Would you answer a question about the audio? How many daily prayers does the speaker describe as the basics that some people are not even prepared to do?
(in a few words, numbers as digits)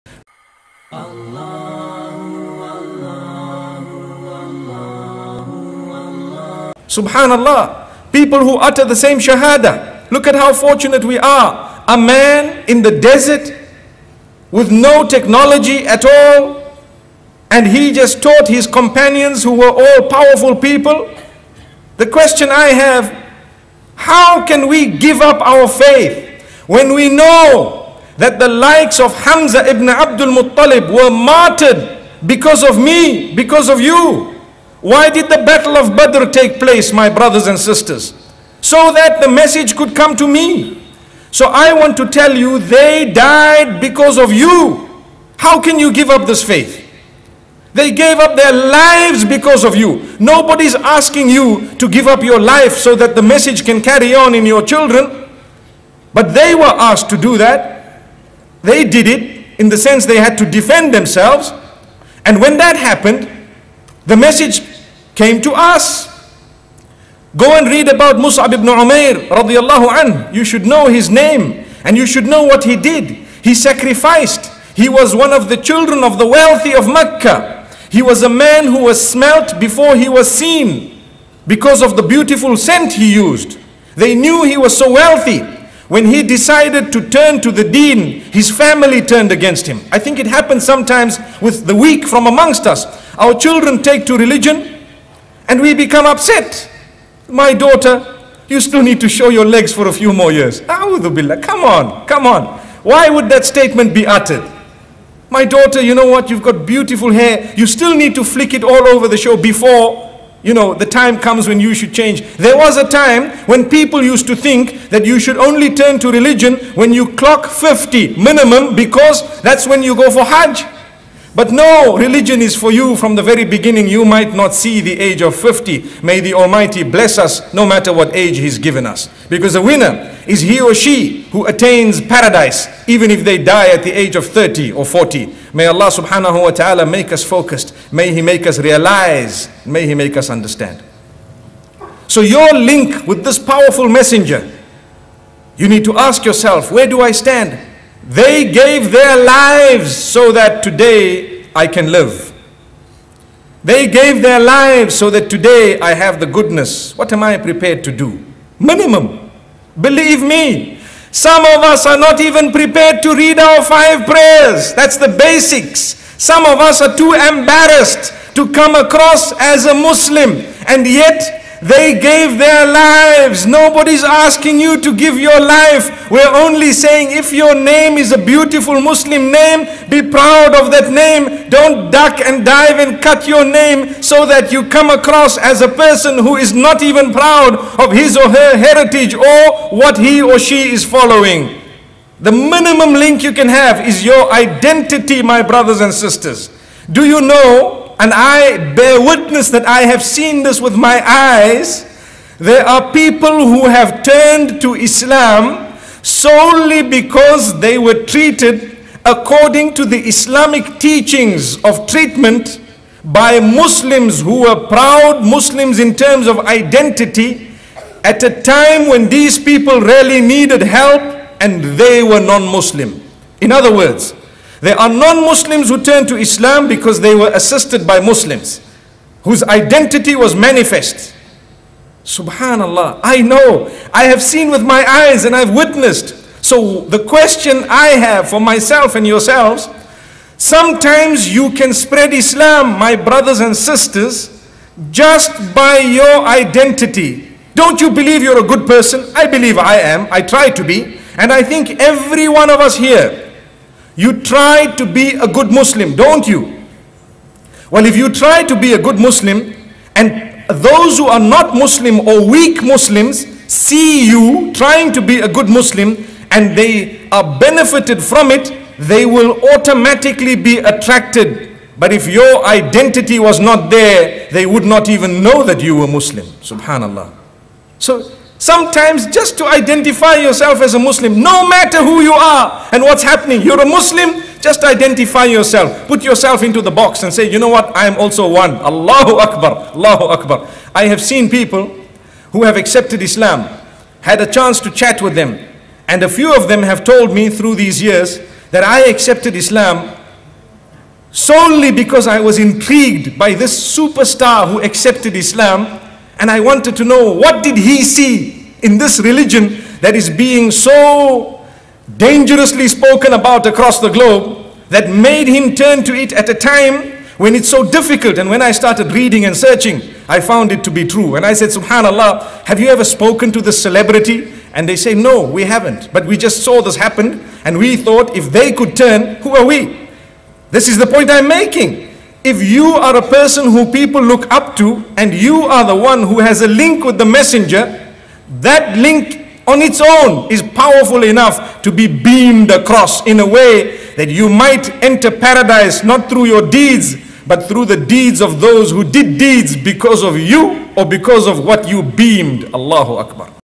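5.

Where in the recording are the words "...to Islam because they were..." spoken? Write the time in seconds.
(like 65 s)
226 s.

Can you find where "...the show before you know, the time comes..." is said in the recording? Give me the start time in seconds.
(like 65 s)
109 s.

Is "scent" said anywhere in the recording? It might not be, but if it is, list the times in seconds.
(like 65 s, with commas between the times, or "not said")
82 s.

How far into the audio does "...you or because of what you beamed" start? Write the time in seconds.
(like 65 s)
350 s.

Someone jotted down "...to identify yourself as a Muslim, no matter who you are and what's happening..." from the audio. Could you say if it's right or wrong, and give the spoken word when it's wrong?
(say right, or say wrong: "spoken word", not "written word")
right.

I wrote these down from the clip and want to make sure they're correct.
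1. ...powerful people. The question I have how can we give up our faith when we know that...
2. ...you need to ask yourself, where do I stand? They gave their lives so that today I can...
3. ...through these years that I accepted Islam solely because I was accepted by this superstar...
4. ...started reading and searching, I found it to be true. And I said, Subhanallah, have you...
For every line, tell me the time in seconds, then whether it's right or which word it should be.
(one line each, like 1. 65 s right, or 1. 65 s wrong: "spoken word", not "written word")
1. 20 s right
2. 145 s right
3. 297 s wrong: "intrigued", not "accepted"
4. 318 s right.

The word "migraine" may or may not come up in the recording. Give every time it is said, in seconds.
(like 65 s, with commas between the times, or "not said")
not said.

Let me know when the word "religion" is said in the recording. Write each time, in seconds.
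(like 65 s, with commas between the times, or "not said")
94 s, 116 s, 121 s, 308 s.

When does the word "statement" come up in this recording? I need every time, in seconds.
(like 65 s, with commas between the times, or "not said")
103 s.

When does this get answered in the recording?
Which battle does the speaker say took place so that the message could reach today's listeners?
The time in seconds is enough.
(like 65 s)
35 s.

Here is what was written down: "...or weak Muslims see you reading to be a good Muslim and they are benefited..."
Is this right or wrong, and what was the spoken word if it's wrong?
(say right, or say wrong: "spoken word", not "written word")
wrong: "trying", not "reading".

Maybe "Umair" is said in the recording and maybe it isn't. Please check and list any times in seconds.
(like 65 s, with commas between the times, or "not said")
68 s.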